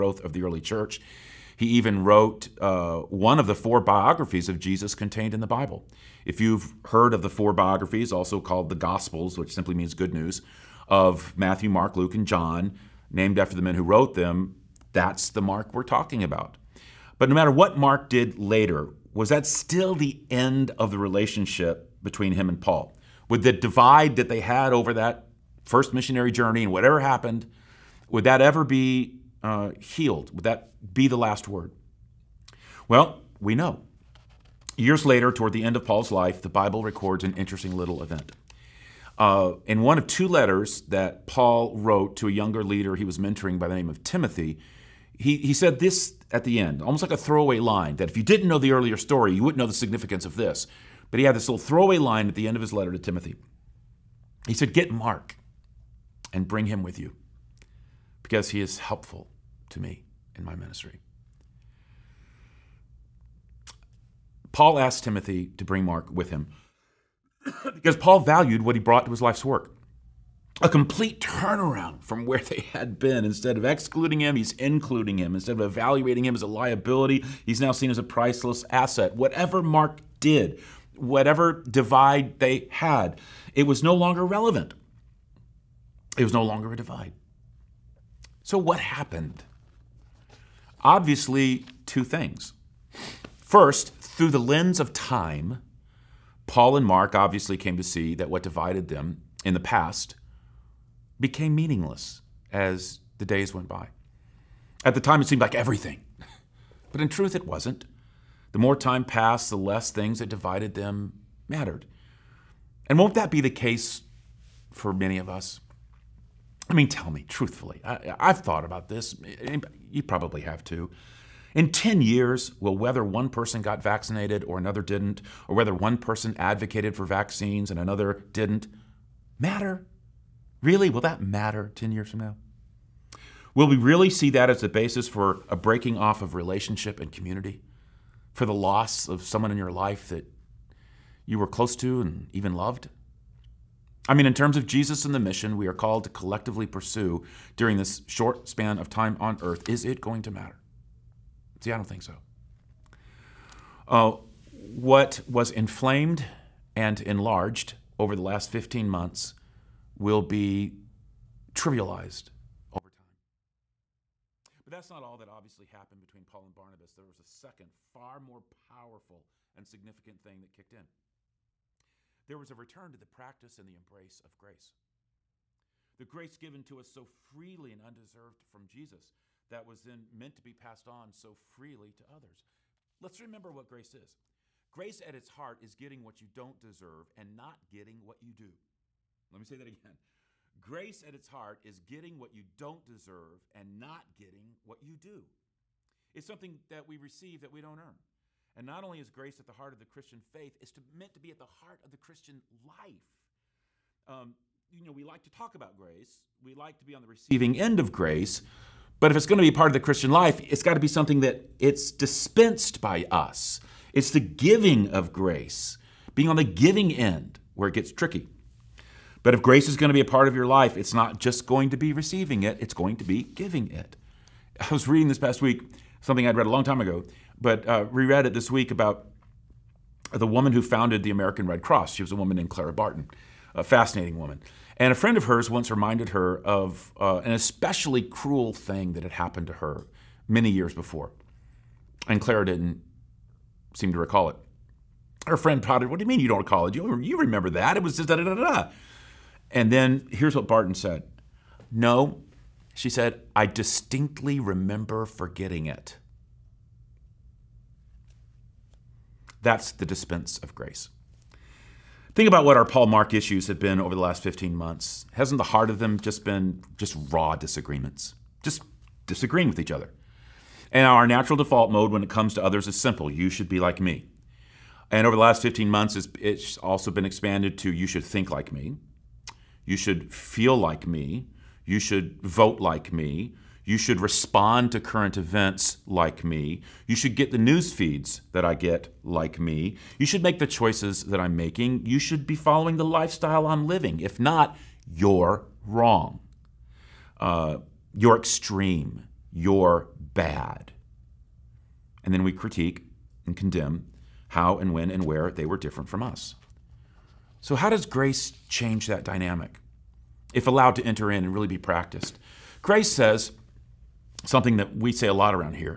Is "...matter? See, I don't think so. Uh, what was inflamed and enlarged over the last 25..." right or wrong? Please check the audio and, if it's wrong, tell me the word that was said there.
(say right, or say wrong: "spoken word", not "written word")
wrong: "15", not "25".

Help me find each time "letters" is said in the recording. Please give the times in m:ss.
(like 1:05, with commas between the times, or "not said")
0:40, 0:52.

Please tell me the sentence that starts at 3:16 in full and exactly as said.
It's something that we receive that we don't earn.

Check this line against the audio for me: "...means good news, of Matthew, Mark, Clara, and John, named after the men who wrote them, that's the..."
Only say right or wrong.
wrong.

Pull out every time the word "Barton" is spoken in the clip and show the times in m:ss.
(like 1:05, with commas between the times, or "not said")
3:52, 4:10.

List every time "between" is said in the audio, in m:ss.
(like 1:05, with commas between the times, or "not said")
0:22, 2:45.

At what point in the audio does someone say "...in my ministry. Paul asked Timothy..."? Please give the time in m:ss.
1:00.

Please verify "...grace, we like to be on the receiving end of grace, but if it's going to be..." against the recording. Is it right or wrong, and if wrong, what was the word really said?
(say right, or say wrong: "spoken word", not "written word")
right.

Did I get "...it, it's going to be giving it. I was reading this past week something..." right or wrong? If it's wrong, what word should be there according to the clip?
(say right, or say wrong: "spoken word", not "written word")
right.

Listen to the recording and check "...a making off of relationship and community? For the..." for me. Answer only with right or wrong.
wrong.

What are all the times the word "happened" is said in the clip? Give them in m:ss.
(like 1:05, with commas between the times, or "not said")
0:26, 1:28, 2:45, 3:59.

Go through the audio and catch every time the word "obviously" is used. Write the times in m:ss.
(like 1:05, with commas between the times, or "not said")
1:30, 1:37, 2:45.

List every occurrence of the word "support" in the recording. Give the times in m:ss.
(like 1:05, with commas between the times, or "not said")
not said.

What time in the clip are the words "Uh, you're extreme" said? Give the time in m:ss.
4:57.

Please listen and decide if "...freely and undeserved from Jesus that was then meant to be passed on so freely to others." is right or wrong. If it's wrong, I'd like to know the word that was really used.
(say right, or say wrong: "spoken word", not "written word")
right.